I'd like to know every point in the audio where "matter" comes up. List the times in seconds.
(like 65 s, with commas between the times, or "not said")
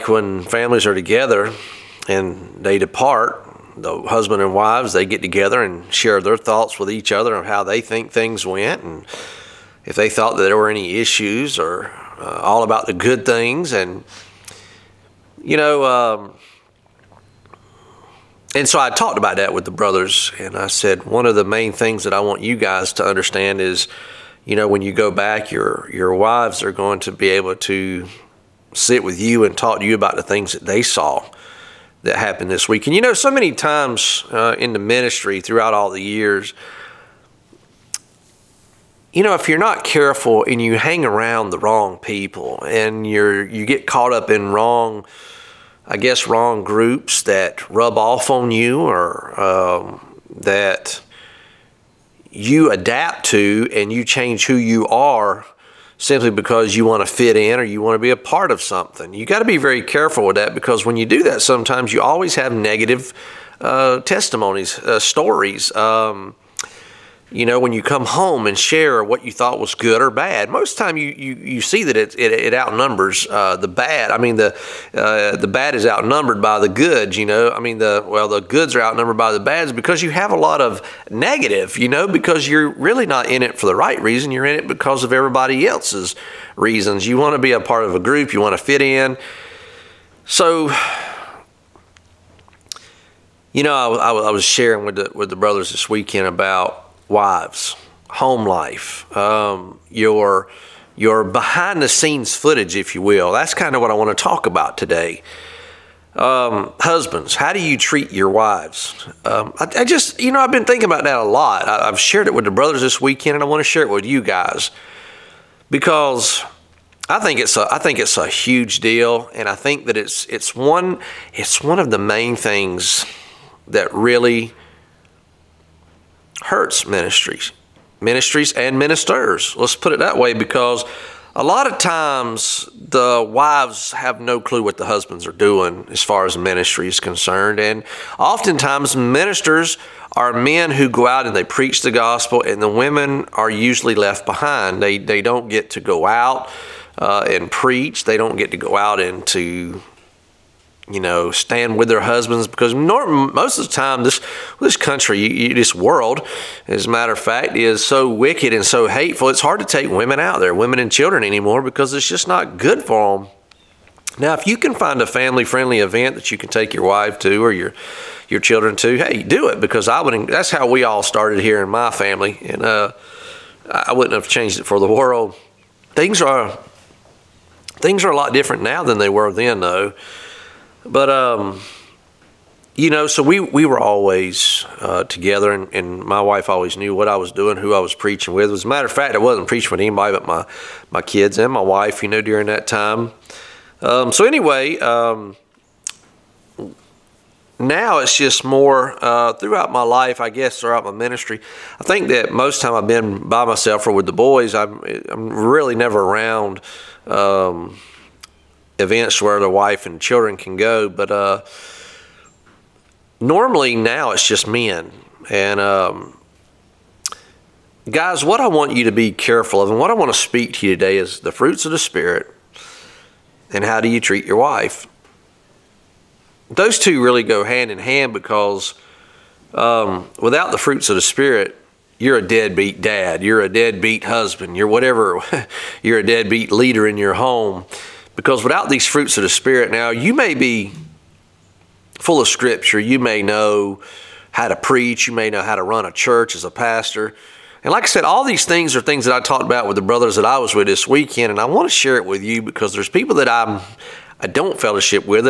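156 s, 188 s.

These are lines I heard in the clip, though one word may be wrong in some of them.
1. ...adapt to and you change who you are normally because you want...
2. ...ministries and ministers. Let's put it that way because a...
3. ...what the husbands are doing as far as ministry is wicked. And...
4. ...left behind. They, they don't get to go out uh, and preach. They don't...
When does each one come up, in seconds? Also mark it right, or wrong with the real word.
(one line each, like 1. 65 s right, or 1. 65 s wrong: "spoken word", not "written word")
1. 52 s wrong: "simply", not "normally"
2. 128 s right
3. 134 s wrong: "concerned", not "wicked"
4. 143 s right.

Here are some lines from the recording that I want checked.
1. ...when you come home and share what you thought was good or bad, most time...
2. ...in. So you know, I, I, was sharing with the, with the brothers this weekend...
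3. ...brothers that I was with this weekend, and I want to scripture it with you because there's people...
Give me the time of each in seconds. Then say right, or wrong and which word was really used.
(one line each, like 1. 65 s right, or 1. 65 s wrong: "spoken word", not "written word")
1. 67 s right
2. 88 s right
3. 249 s wrong: "share", not "scripture".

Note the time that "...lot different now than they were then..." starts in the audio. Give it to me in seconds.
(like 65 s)
178 s.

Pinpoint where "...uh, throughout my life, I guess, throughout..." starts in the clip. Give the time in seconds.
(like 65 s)
199 s.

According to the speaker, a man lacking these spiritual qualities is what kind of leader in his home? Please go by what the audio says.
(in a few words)
a deadbeat leader.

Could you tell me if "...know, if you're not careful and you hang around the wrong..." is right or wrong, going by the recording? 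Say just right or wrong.
right.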